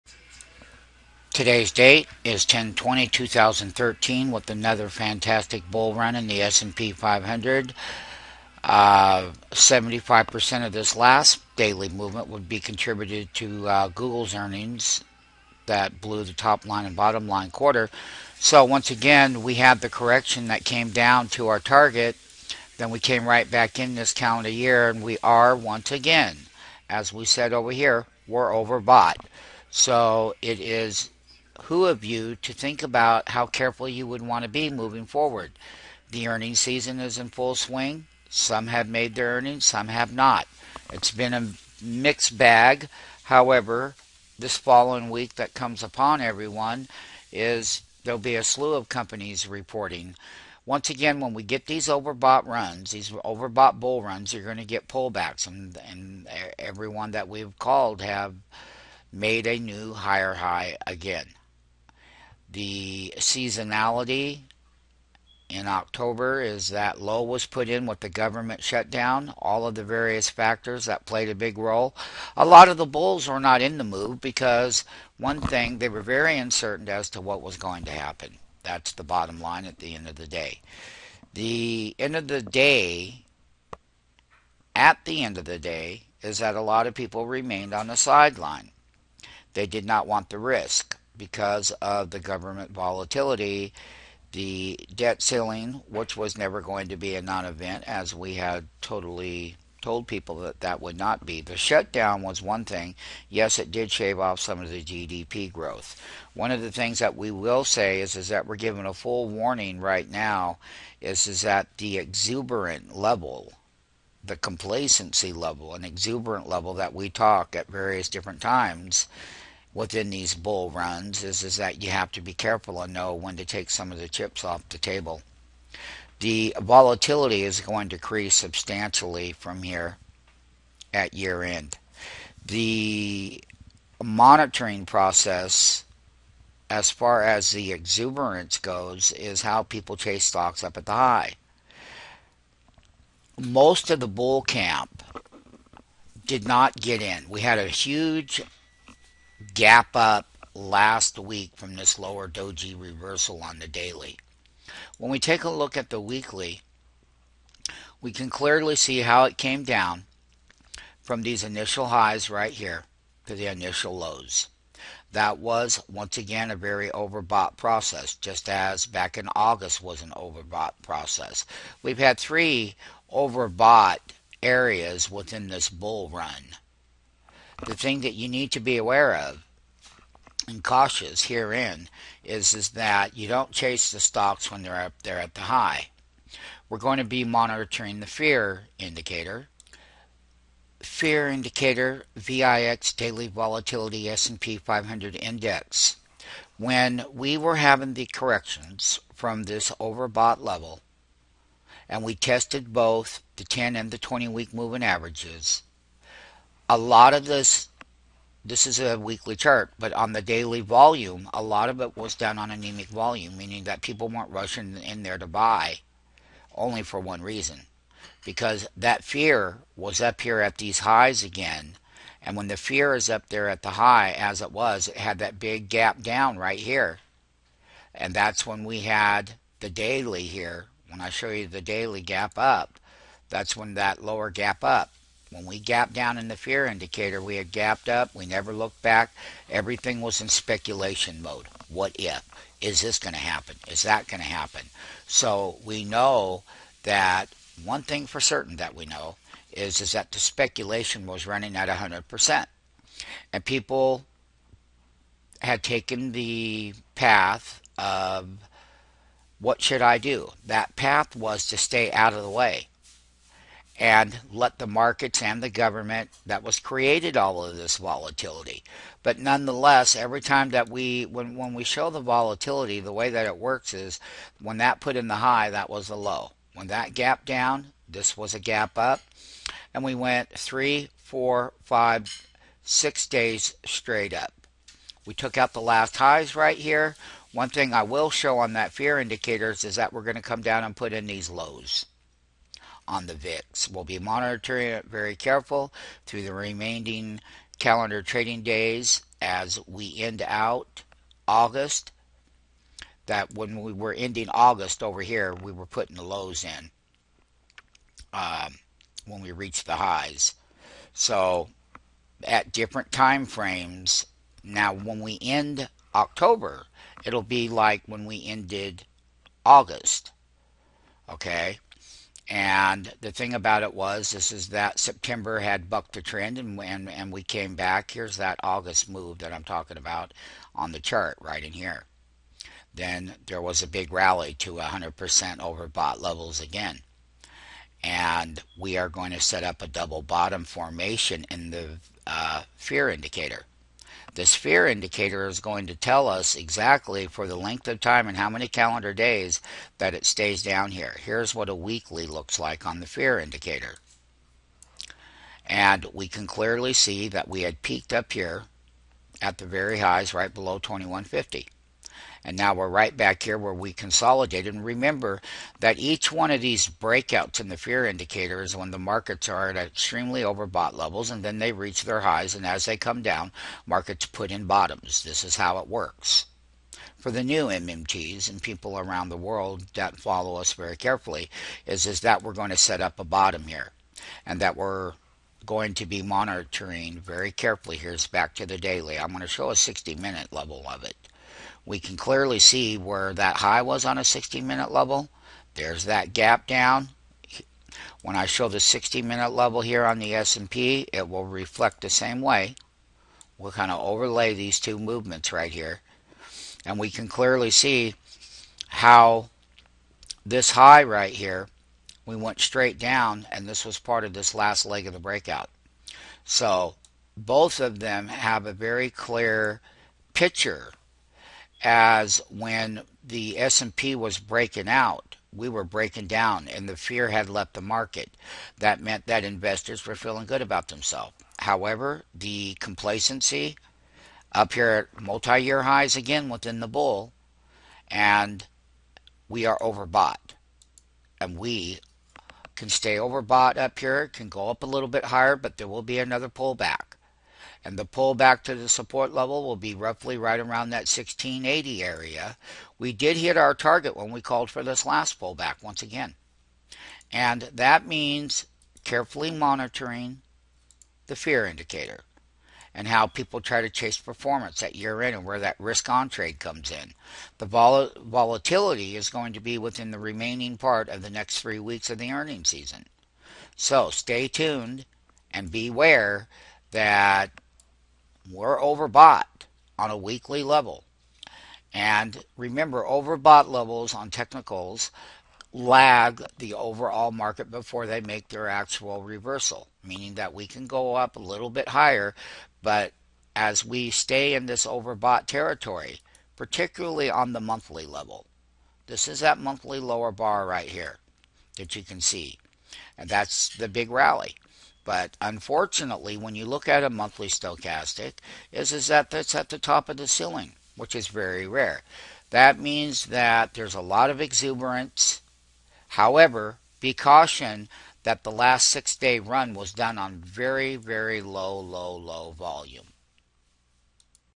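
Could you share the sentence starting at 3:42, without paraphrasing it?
And when the fear is up there at the high, as it was, it had that big gap down right here.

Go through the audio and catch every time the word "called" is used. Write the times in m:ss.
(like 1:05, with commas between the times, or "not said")
0:57, 7:34.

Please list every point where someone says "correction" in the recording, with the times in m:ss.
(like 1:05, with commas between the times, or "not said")
0:19, 3:18.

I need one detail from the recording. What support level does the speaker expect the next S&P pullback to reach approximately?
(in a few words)
1680.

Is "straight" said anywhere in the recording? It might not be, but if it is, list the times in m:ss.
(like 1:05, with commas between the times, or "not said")
4:43, 6:52.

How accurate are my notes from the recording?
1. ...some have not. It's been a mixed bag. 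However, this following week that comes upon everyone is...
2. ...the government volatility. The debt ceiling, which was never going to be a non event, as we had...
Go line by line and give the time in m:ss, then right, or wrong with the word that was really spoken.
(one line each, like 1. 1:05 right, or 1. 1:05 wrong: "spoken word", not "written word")
1. 0:39 right
2. 1:32 right.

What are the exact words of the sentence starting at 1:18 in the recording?
That's the bottom line at the end of the day.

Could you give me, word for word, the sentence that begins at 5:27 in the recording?
Here's that August move that I'm talking about on the chart right in here.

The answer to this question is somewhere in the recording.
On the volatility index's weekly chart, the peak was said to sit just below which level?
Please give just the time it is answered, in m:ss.
6:00.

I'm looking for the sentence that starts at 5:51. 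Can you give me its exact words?
Here's what a weekly looks like on the fear indicator.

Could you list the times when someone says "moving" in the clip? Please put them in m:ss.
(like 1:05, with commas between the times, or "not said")
0:34, 3:24.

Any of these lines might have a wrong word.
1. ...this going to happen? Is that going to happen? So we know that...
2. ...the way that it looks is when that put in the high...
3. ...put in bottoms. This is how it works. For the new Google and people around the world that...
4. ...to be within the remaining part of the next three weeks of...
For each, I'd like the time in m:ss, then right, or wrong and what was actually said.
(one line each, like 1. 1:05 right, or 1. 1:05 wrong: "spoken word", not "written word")
1. 4:02 right
2. 4:32 wrong: "works", not "looks"
3. 6:14 wrong: "MMTs", not "Google"
4. 7:49 right.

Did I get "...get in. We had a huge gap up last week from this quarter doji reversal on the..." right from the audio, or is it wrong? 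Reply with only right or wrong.
wrong.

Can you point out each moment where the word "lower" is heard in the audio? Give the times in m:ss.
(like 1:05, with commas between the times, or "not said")
2:31, 3:54, 8:19.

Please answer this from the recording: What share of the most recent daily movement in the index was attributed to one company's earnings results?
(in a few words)
75%.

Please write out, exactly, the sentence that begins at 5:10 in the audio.
So at different time frames, now when we end October, it'll be like when we ended August.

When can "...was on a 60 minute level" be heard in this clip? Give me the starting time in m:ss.
6:33.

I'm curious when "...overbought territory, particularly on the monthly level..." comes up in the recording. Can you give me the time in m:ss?
8:14.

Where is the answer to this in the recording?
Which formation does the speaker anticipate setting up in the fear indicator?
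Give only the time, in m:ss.
5:39.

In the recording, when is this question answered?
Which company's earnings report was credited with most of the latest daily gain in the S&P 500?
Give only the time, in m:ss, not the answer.
0:13.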